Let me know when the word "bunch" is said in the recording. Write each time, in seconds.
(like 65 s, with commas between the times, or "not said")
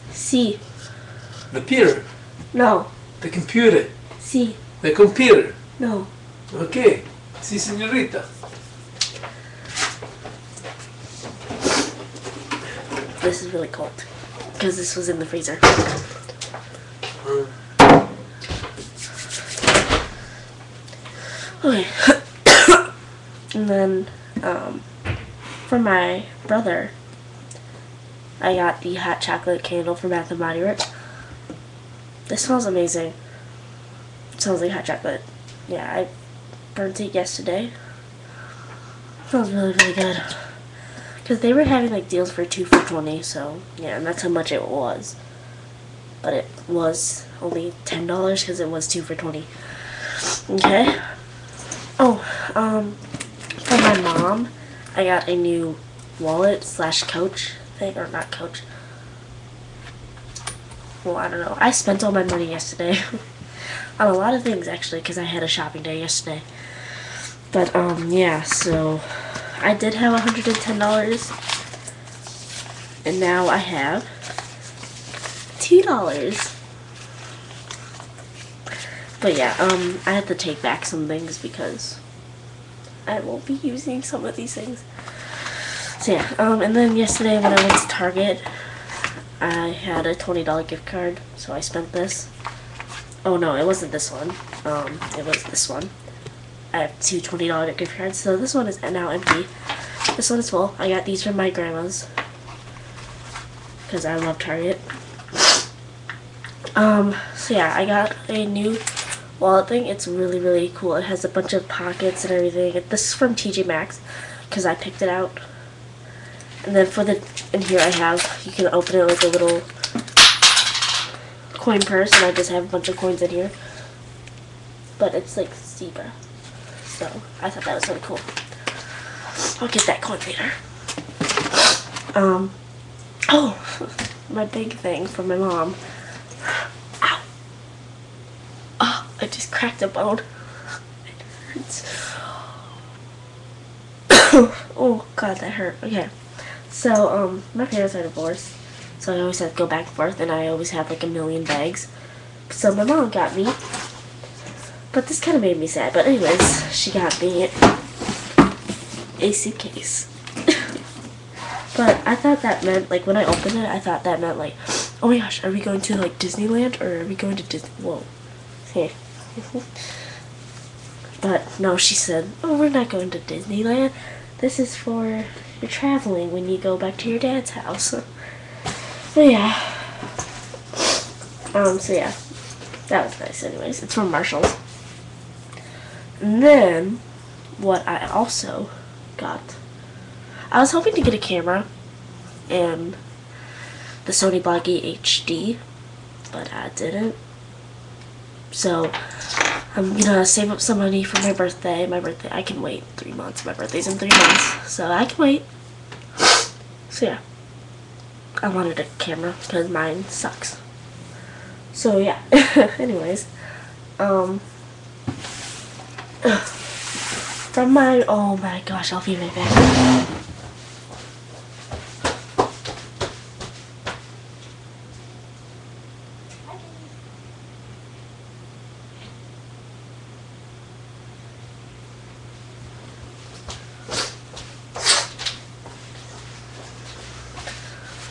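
111 s, 122 s.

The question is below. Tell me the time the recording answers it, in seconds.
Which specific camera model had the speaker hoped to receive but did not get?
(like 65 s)
194 s.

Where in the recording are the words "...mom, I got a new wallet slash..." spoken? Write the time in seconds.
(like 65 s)
54 s.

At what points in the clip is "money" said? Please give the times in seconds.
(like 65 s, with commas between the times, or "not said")
62 s, 200 s.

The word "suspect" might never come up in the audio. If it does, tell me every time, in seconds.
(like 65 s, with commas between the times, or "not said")
not said.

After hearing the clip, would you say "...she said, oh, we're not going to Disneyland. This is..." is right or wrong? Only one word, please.
right.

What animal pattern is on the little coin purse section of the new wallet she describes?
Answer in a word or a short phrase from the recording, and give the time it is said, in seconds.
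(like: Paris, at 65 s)
zebra, at 125 s.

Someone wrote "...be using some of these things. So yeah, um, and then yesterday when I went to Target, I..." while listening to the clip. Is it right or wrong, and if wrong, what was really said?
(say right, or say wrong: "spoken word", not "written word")
right.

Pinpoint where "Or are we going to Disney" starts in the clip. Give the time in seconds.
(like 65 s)
166 s.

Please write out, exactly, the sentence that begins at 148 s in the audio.
So I always have to go back and forth, and I always have like a million bags.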